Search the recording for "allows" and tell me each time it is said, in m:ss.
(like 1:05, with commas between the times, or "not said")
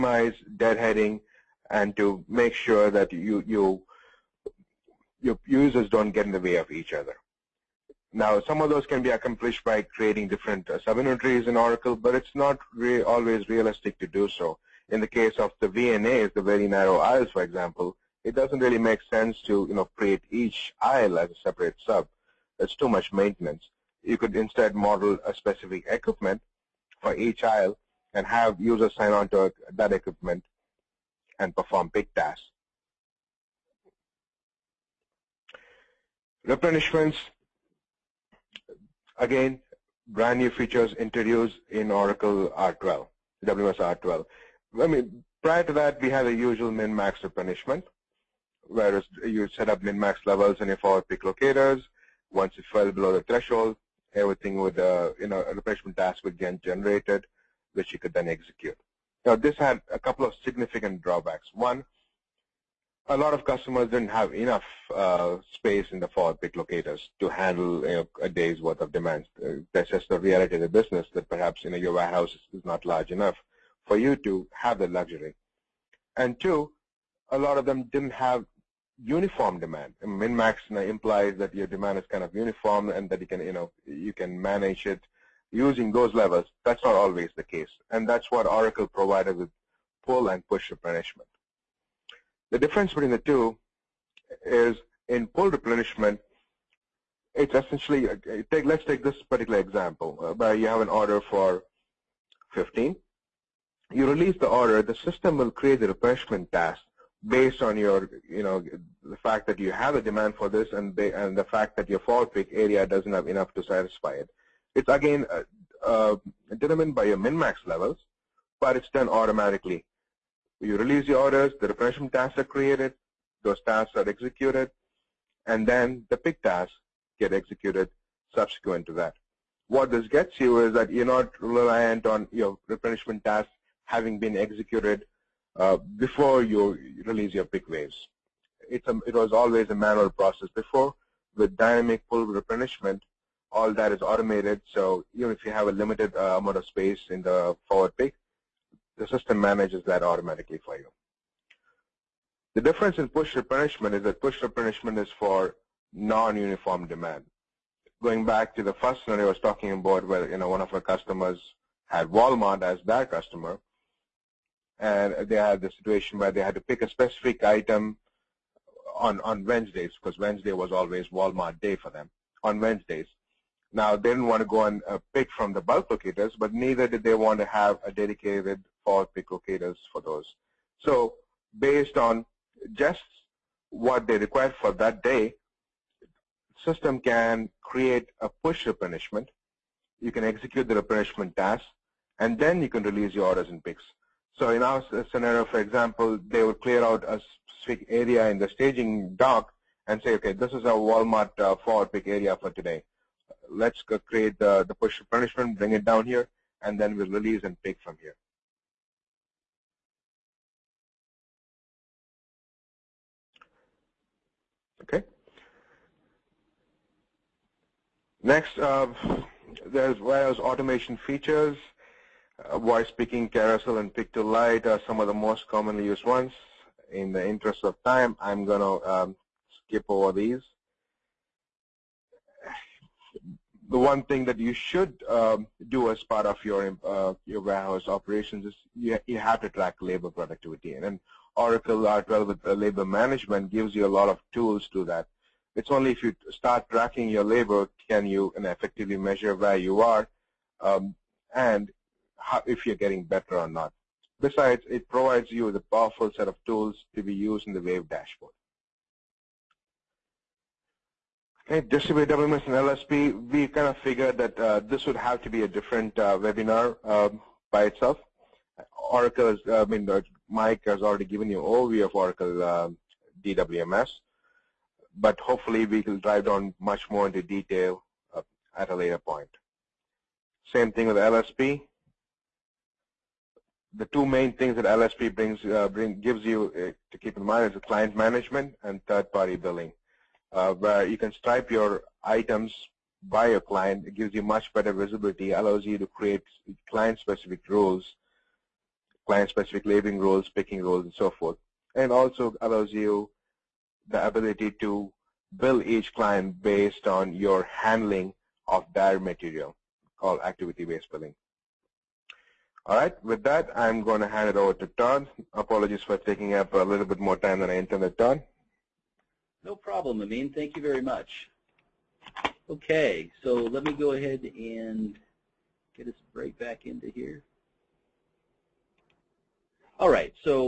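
4:55, 5:02.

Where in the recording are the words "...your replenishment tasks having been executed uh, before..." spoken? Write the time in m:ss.
2:12.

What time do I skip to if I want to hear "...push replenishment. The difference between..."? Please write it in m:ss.
1:30.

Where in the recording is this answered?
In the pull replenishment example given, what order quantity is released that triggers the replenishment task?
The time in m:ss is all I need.
1:42.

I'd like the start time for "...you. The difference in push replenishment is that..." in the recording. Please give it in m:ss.
2:30.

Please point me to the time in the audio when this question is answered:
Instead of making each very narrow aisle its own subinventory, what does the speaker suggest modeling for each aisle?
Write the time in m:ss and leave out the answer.
0:25.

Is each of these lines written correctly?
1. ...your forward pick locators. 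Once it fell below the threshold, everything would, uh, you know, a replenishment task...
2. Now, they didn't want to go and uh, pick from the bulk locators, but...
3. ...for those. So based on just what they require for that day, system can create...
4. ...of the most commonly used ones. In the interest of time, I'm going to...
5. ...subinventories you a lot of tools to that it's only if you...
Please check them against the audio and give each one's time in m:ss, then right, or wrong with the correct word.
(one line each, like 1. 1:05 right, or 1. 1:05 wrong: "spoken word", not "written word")
1. 0:50 right
2. 2:53 right
3. 2:59 right
4. 3:45 right
5. 4:03 wrong: "gives", not "subinventories".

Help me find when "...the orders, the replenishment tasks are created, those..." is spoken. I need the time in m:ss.
2:01.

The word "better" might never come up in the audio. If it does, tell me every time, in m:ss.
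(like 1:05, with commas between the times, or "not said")
4:13, 4:54.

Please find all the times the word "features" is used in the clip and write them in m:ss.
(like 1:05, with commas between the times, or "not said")
0:40, 3:40.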